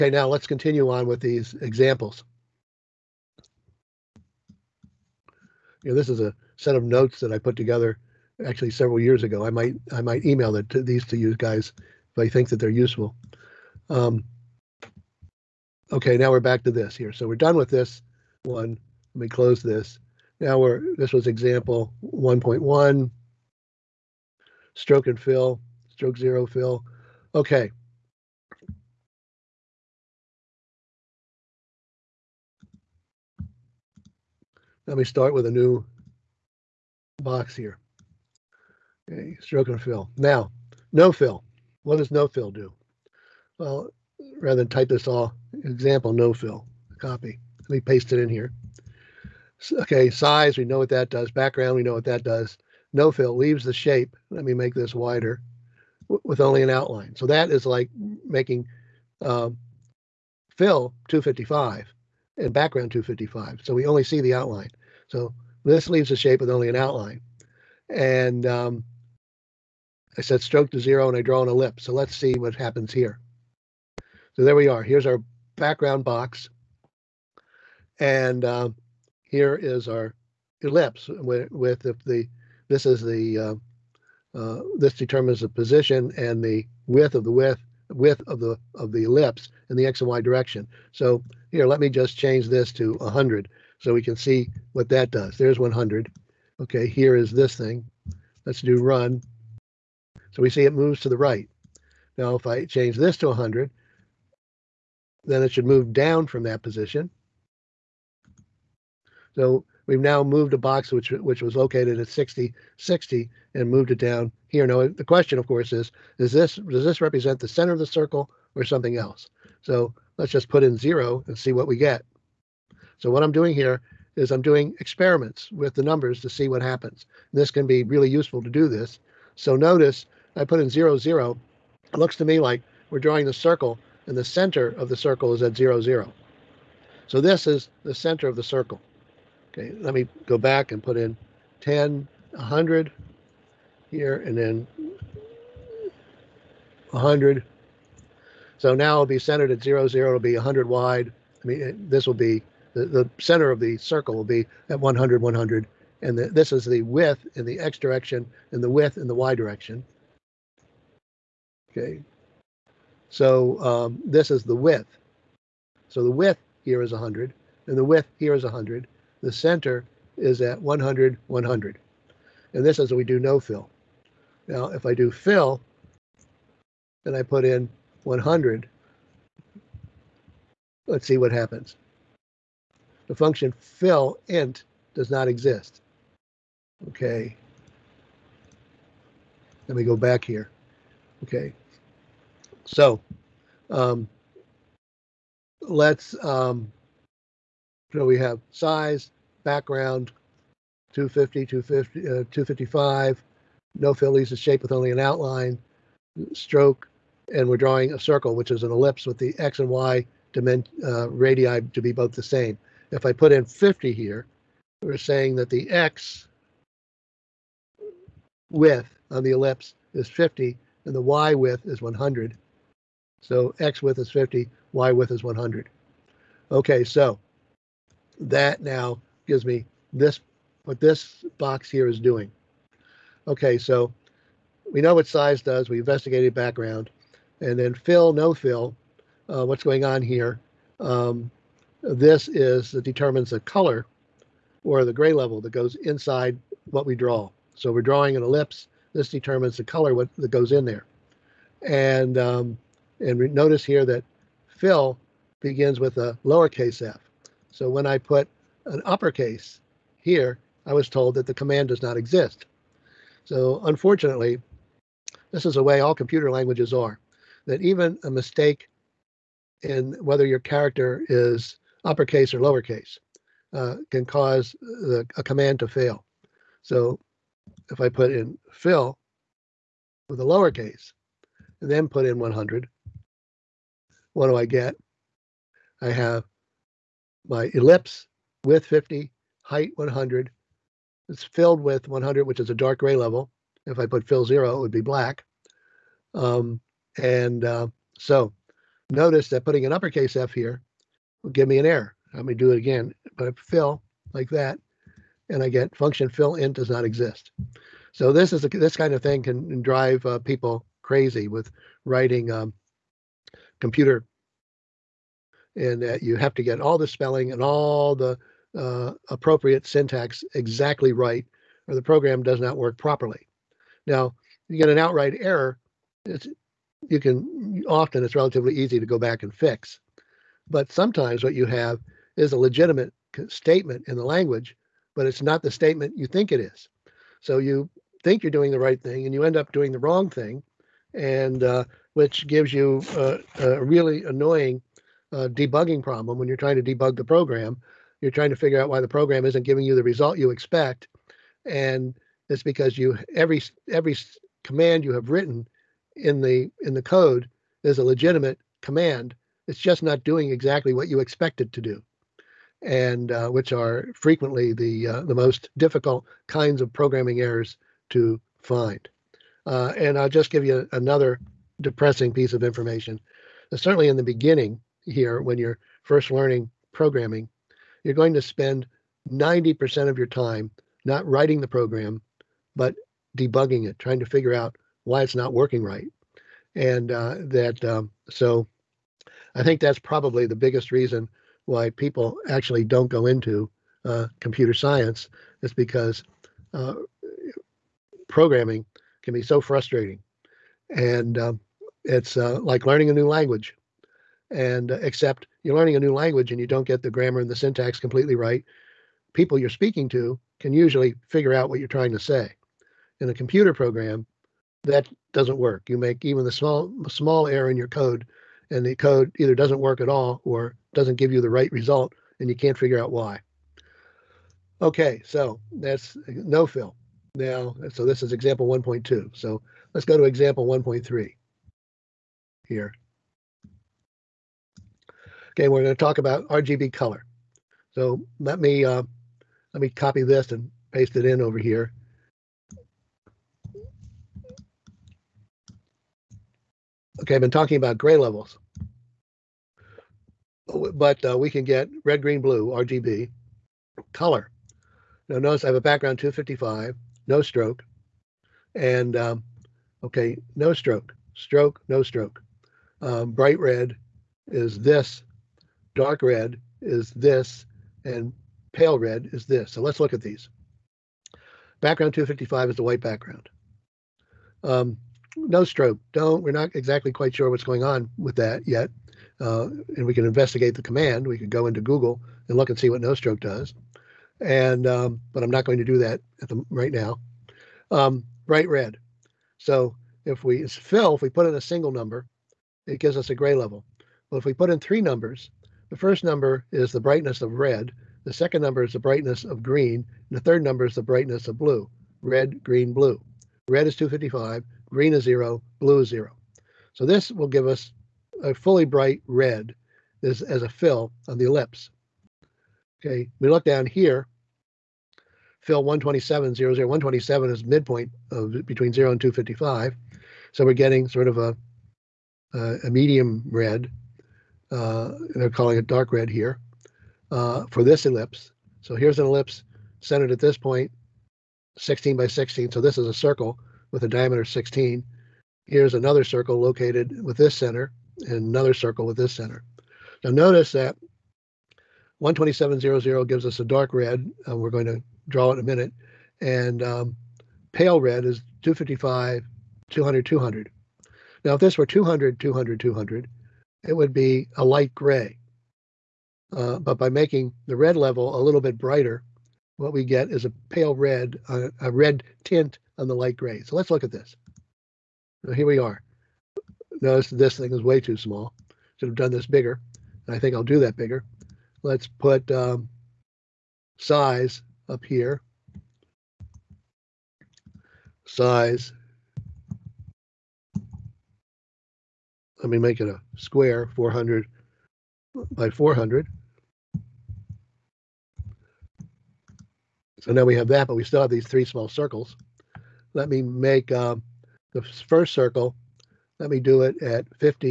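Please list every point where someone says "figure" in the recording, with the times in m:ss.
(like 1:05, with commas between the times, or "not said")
5:48, 6:24, 6:51, 7:02.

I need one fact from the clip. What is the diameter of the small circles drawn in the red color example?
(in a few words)
16.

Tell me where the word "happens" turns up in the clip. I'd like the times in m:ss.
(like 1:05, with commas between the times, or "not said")
1:12, 2:06, 3:01.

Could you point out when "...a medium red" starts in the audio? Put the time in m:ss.
8:42.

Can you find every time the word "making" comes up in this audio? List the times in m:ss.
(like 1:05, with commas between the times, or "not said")
0:58, 9:16.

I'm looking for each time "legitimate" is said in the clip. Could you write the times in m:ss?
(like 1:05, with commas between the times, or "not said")
5:32, 5:57.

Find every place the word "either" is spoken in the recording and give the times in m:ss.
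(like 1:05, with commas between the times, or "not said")
6:59.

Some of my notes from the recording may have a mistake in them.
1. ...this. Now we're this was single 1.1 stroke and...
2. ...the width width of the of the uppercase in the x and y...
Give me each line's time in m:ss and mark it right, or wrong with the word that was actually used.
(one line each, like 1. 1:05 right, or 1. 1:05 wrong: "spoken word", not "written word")
1. 0:19 wrong: "example", not "single"
2. 1:27 wrong: "ellipse", not "uppercase".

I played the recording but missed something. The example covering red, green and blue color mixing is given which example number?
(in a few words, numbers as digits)
1.3.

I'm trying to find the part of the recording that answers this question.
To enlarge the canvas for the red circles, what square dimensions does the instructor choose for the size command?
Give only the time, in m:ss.
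9:43.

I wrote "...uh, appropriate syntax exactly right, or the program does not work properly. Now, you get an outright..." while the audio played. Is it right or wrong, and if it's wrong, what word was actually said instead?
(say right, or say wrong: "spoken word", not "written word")
right.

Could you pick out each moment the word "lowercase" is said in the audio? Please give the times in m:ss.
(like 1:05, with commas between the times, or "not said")
4:16, 4:32, 4:40.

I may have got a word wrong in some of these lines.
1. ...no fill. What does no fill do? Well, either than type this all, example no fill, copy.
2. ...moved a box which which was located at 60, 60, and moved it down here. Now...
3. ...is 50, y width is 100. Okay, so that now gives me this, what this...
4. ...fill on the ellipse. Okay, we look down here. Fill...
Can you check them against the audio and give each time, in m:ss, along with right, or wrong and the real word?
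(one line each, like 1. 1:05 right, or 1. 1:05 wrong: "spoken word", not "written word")
1. 0:40 wrong: "rather", not "either"
2. 1:50 right
3. 3:43 right
4. 8:30 right.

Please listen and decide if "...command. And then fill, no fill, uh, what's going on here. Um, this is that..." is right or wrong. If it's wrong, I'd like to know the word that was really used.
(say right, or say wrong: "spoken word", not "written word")
wrong: "background", not "command".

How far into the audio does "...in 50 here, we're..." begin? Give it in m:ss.
3:33.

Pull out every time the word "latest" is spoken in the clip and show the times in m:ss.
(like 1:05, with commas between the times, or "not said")
not said.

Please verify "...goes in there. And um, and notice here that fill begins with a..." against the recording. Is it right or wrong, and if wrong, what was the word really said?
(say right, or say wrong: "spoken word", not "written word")
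right.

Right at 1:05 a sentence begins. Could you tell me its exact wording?
So this leaves a shape with only an outline.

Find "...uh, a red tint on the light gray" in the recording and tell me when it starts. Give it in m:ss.
9:21.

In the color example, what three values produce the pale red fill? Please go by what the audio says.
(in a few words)
255, 200, 200.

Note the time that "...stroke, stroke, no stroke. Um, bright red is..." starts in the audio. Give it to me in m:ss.
7:40.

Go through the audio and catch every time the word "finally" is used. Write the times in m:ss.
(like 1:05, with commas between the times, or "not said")
not said.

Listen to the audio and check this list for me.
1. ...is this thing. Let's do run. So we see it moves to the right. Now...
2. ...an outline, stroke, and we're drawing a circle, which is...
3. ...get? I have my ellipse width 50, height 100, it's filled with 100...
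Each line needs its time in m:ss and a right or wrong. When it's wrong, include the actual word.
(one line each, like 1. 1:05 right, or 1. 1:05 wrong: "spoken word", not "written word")
1. 1:37 right
2. 3:24 right
3. 4:44 right.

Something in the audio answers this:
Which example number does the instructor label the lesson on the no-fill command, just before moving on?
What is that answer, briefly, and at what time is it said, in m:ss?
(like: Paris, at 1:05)
1.2, at 7:08.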